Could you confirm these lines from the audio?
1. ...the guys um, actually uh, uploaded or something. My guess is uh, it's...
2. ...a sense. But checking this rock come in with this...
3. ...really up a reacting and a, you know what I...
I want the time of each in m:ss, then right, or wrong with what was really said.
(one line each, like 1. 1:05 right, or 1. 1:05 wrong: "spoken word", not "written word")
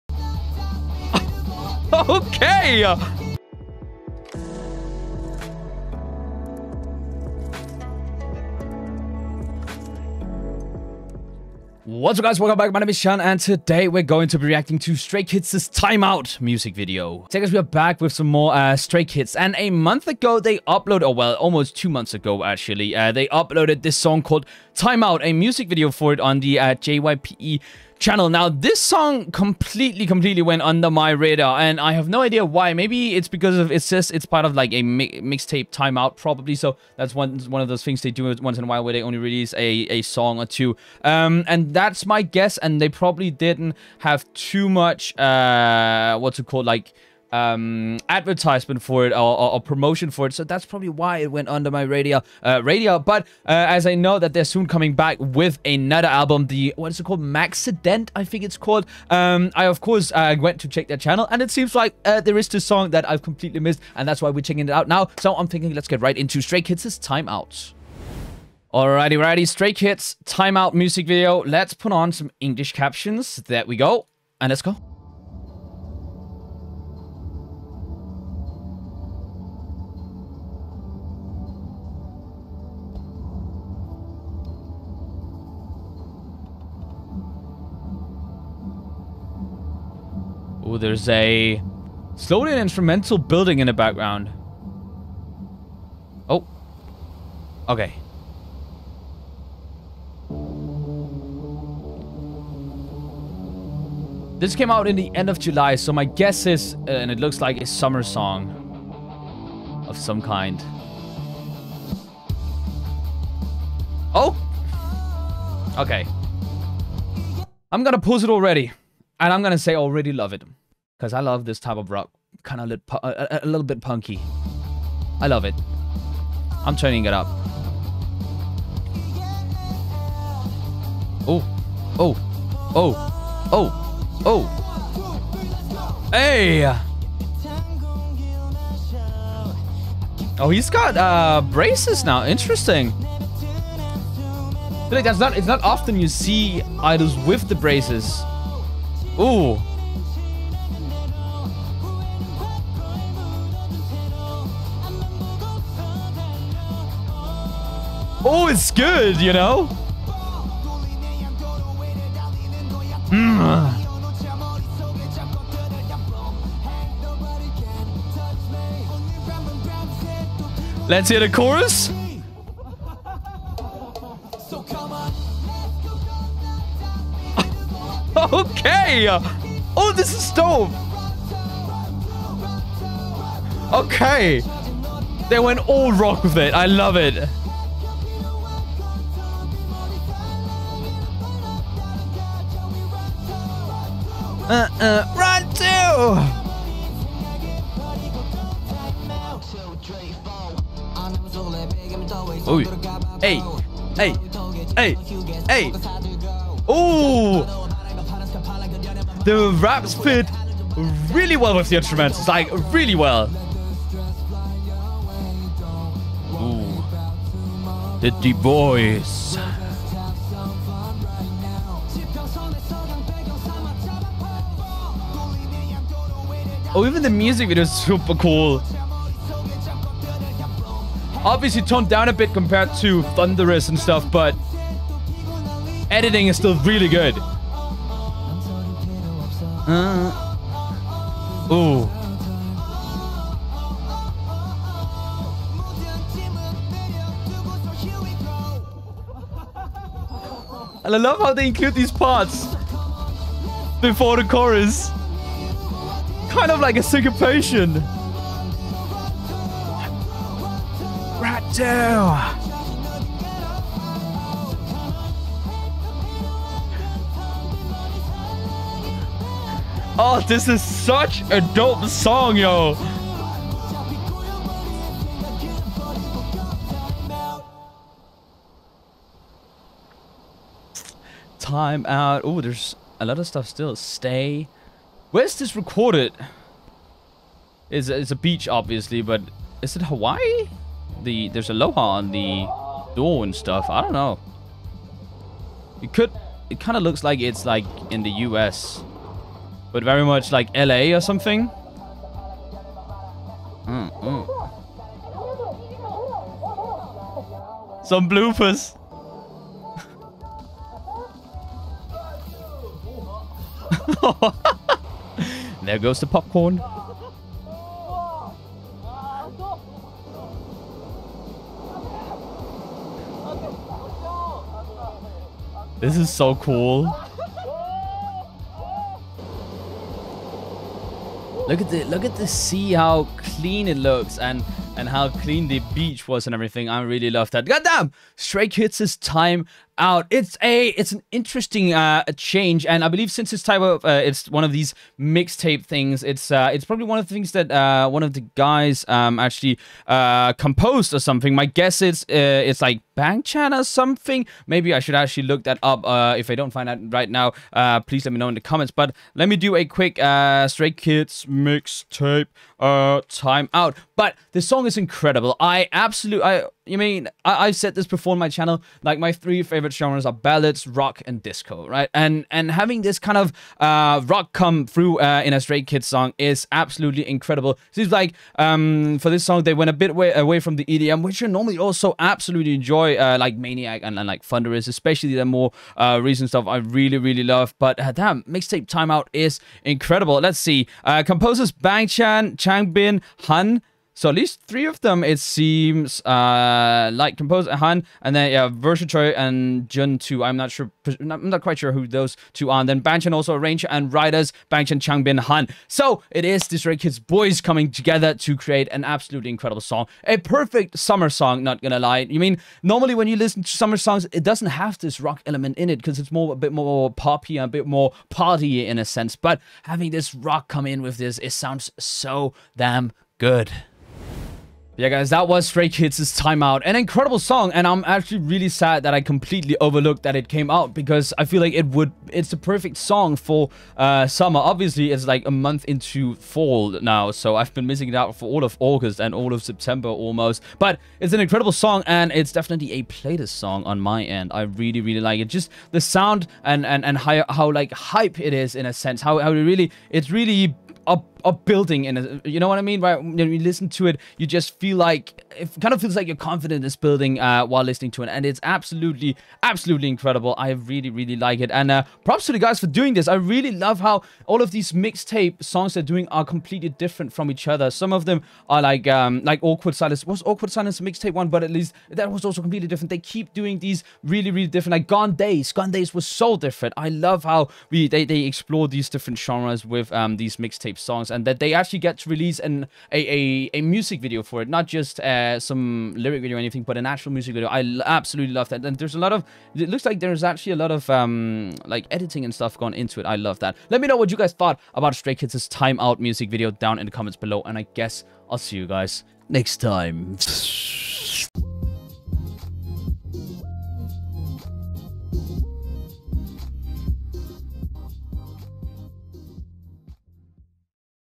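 1. 5:48 wrong: "composed", not "uploaded"
2. 6:58 wrong: "having", not "checking"
3. 7:30 wrong: "building", not "reacting".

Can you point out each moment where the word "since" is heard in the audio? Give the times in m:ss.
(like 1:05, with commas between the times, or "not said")
5:43.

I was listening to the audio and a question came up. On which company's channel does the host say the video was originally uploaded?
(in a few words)
JYPE.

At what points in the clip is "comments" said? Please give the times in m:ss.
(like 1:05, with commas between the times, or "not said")
5:58, 8:16.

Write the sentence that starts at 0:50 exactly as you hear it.
So that's probably why it went under my radio.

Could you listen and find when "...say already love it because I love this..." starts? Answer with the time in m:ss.
1:59.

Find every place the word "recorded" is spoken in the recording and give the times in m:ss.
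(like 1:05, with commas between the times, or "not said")
4:45.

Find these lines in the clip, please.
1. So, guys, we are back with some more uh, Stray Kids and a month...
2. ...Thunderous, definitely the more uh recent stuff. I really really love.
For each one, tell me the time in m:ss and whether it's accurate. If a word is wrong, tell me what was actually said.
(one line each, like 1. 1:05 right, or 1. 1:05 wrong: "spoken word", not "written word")
1. 0:17 right
2. 6:24 wrong: "especially", not "definitely".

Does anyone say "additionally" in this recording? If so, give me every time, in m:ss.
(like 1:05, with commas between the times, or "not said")
not said.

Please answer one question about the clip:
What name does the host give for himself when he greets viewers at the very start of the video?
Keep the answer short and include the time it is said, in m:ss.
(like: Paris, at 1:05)
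Shun, at 0:12.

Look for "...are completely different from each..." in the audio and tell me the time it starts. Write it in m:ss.
7:46.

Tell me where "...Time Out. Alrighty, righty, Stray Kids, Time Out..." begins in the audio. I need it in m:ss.
1:06.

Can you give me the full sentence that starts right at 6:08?
Like my three favorite favorite genres are ballads, rock, and disco, right?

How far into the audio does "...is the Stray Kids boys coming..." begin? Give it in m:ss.
6:46.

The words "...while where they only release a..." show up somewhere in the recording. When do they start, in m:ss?
0:38.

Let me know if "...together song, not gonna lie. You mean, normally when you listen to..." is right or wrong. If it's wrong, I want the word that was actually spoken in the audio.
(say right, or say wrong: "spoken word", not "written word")
wrong: "summer", not "together".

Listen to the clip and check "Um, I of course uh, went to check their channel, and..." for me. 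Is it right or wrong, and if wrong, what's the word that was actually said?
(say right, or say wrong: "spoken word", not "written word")
right.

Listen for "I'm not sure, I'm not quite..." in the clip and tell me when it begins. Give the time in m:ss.
6:40.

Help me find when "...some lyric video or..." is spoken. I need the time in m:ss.
8:05.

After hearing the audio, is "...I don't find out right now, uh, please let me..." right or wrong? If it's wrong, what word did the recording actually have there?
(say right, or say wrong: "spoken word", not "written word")
right.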